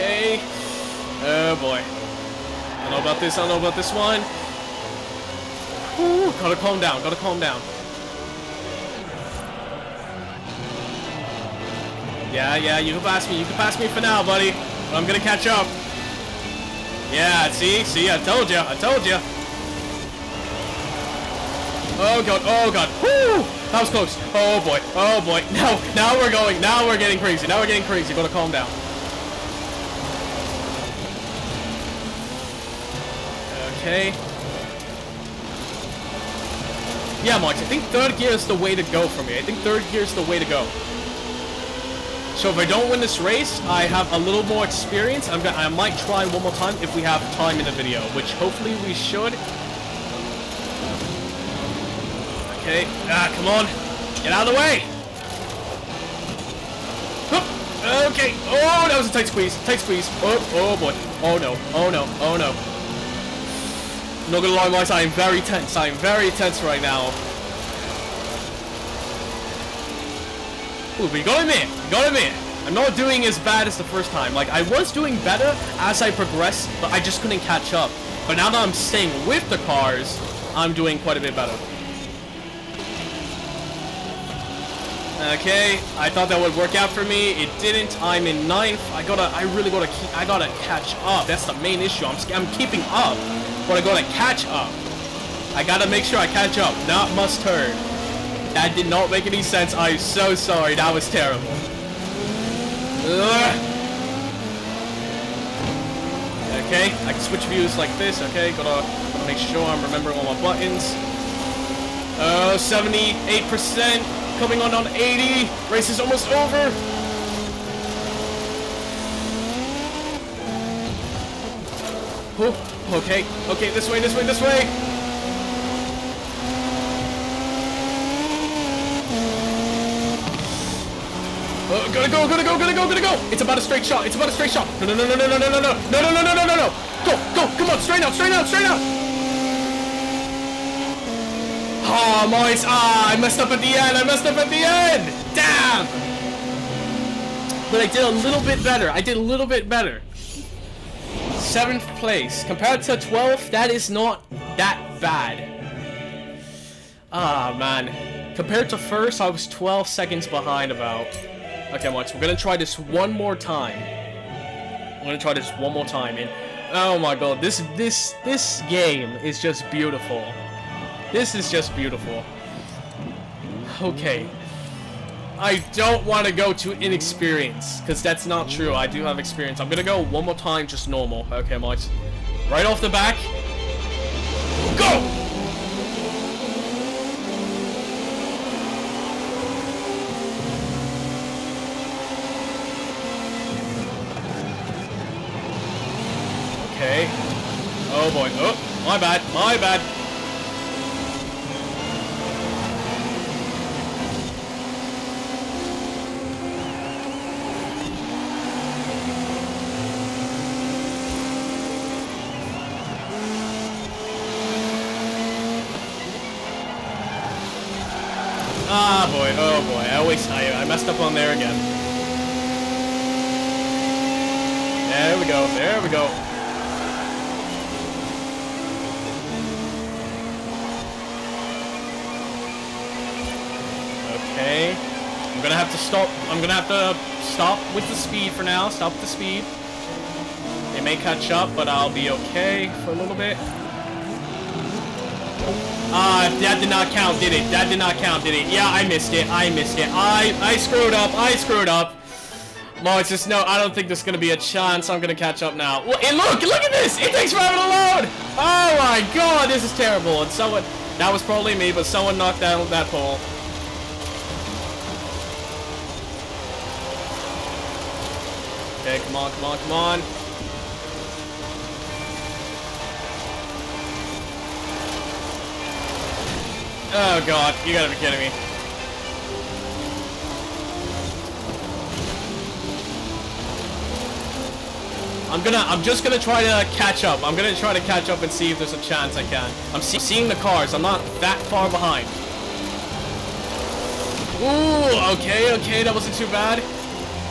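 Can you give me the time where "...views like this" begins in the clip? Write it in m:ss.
1:47.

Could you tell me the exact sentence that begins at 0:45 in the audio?
I'm gonna, I might try one more time if we have time in the video, which hopefully we should.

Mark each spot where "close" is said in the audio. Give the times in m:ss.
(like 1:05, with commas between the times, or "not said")
0:23.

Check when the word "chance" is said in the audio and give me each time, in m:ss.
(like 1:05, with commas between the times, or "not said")
4:14, 4:48.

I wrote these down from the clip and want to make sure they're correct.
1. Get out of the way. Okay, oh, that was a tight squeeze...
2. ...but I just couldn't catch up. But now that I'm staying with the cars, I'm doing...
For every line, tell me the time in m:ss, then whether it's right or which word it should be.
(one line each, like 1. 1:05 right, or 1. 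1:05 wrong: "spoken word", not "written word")
1. 0:54 right
2. 1:16 right.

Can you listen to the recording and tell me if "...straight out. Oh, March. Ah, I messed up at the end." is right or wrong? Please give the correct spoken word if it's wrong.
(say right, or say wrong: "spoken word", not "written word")
wrong: "Moise", not "March".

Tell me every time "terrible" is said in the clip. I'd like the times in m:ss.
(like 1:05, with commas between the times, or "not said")
1:41, 4:19.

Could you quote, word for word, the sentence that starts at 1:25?
Okay, I thought that would work out for me.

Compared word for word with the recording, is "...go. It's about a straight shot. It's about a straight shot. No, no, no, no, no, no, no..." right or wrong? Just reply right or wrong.
right.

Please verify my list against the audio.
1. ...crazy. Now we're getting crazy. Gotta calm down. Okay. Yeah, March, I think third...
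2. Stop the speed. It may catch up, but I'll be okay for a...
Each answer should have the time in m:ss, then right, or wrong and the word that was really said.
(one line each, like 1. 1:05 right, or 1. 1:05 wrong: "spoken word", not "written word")
1. 0:27 right
2. 3:58 right.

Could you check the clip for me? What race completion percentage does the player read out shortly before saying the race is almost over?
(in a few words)
78%.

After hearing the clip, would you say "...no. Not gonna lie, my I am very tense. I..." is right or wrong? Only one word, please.
right.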